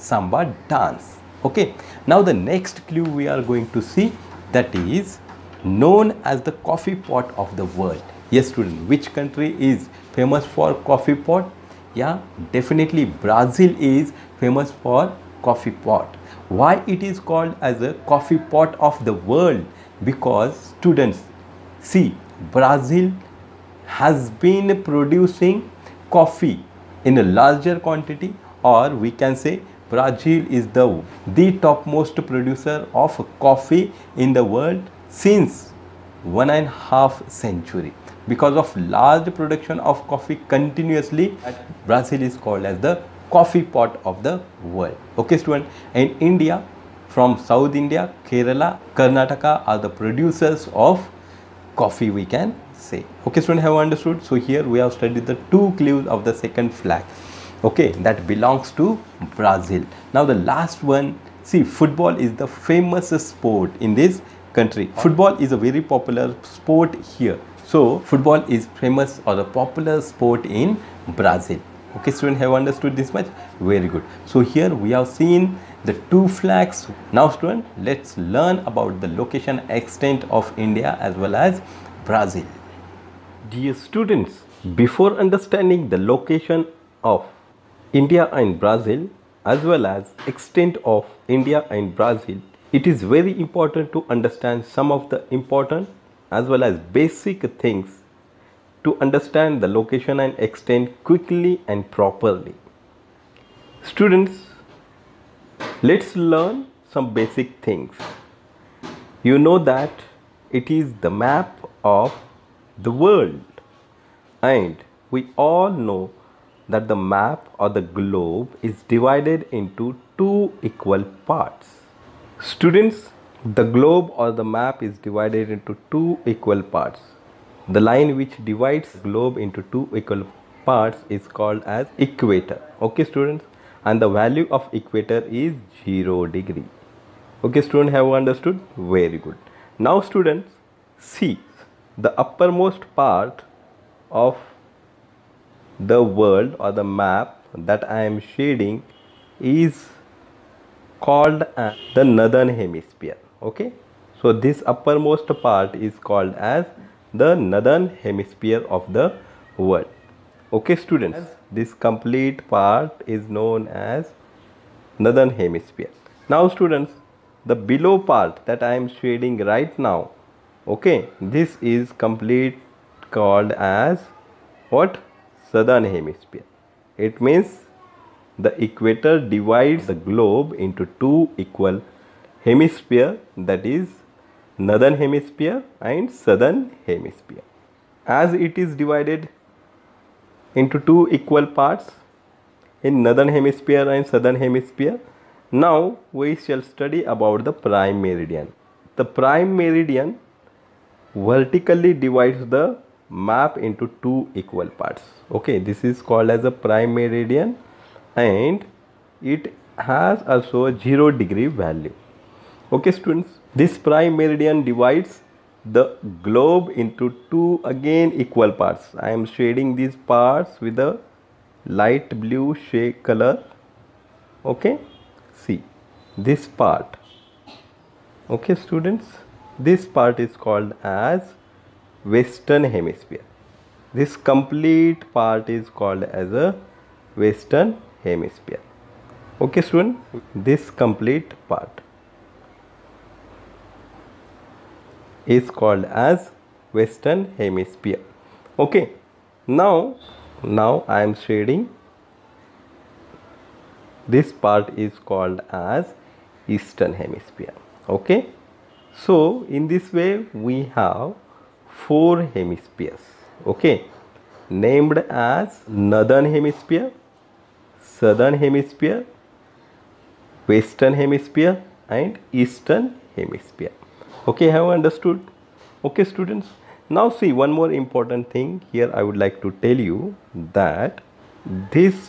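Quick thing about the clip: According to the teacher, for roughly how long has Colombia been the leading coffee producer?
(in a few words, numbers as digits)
1.5 centuries.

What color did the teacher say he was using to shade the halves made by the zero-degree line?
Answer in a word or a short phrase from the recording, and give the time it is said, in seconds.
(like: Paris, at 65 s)
Light blue, at 221 s.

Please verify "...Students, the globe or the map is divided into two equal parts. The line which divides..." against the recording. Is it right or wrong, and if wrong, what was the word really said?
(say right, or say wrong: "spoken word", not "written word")
right.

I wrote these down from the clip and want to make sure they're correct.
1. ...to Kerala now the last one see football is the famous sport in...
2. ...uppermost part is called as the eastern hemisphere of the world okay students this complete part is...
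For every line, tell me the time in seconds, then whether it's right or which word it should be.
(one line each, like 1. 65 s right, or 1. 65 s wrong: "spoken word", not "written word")
1. 58 s wrong: "Brazil", not "Kerala"
2. 154 s wrong: "northern", not "eastern".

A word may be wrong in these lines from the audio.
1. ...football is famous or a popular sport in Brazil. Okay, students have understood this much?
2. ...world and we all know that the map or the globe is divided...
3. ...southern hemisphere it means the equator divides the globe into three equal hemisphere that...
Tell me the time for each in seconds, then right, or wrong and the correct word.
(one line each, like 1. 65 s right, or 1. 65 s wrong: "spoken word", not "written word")
1. 67 s right
2. 112 s right
3. 175 s wrong: "two", not "three".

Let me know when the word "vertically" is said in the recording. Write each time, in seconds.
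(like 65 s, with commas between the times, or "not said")
201 s.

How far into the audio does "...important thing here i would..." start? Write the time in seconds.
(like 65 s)
277 s.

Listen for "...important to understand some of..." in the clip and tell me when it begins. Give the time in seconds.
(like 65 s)
93 s.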